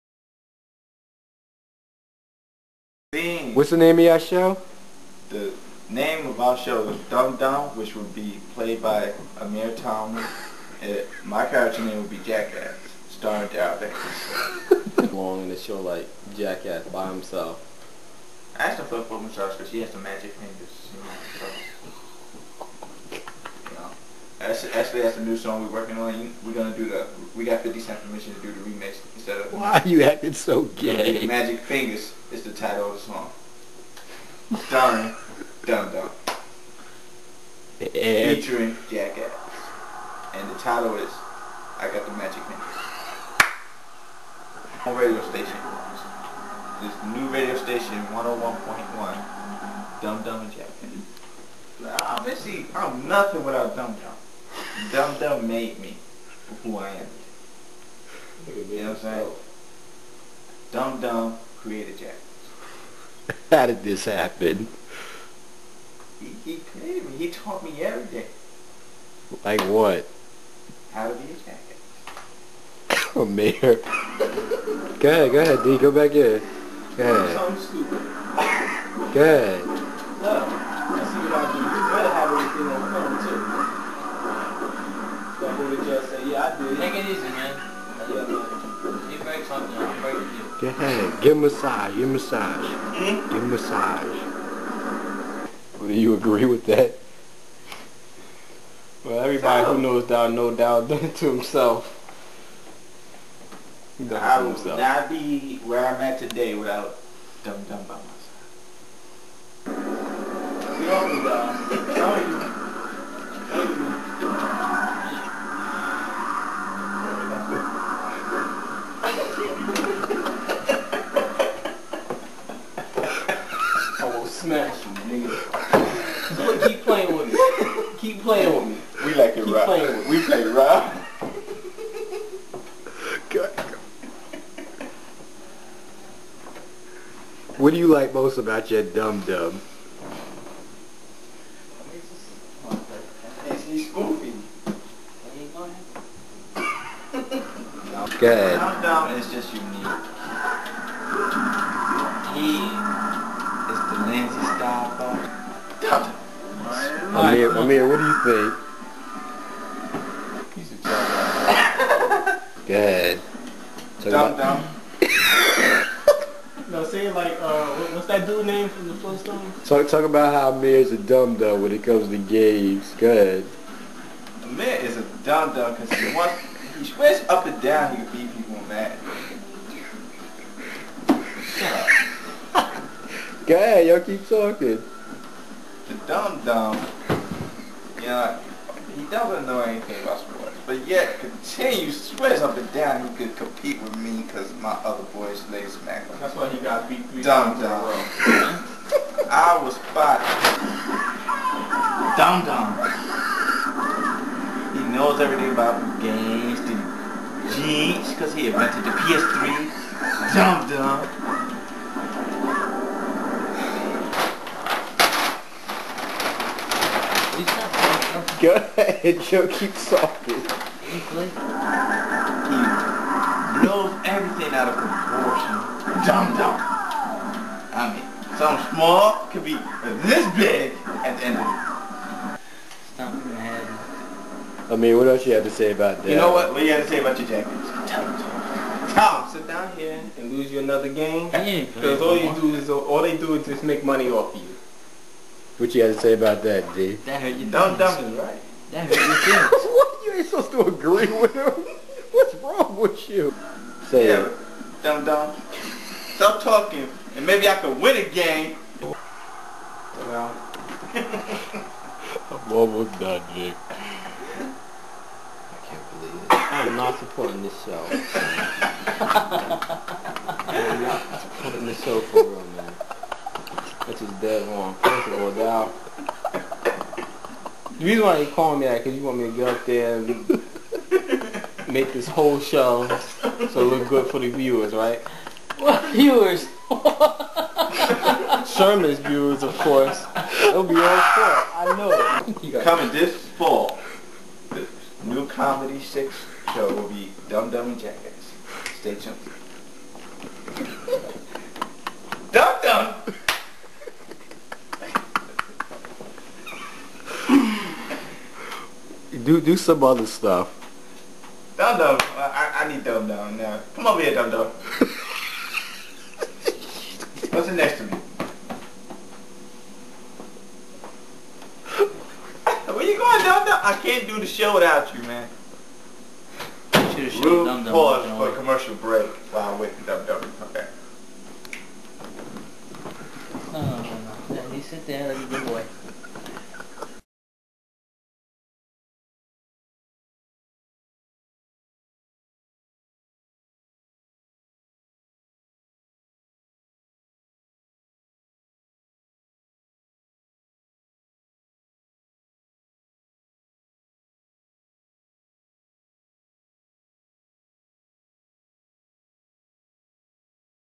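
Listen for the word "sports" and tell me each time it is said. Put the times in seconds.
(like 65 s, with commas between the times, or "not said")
190 s.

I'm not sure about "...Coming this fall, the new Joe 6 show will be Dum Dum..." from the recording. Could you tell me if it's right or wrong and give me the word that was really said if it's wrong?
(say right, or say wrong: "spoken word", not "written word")
wrong: "Comedy", not "Joe".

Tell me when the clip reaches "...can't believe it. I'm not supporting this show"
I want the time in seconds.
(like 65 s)
265 s.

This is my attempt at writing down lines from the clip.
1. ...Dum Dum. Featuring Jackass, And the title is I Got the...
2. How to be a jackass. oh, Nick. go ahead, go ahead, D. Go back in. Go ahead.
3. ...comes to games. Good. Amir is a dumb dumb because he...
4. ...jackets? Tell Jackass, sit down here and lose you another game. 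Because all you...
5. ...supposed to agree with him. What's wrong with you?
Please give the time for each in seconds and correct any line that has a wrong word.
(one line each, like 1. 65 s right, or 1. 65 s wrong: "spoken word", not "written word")
1. 35 s right
2. 70 s wrong: "Mayor", not "Nick"
3. 171 s right
4. 237 s wrong: "Tom", not "Jackass"
5. 250 s right.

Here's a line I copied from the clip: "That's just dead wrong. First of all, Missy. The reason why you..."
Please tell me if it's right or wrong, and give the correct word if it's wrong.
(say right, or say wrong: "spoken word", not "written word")
wrong: "Dow", not "Missy".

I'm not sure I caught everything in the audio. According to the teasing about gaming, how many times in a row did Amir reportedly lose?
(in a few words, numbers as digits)
3.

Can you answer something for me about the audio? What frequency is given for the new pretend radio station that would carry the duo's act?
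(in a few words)
101.1.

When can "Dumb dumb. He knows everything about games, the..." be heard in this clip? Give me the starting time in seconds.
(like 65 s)
202 s.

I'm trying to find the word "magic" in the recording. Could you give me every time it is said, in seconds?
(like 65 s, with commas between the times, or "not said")
19 s, 31 s, 42 s.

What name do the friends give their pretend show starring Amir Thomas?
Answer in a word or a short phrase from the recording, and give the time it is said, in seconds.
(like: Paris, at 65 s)
Dumb Dum, at 7 s.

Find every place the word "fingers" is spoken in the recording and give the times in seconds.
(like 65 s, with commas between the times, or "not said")
20 s, 31 s.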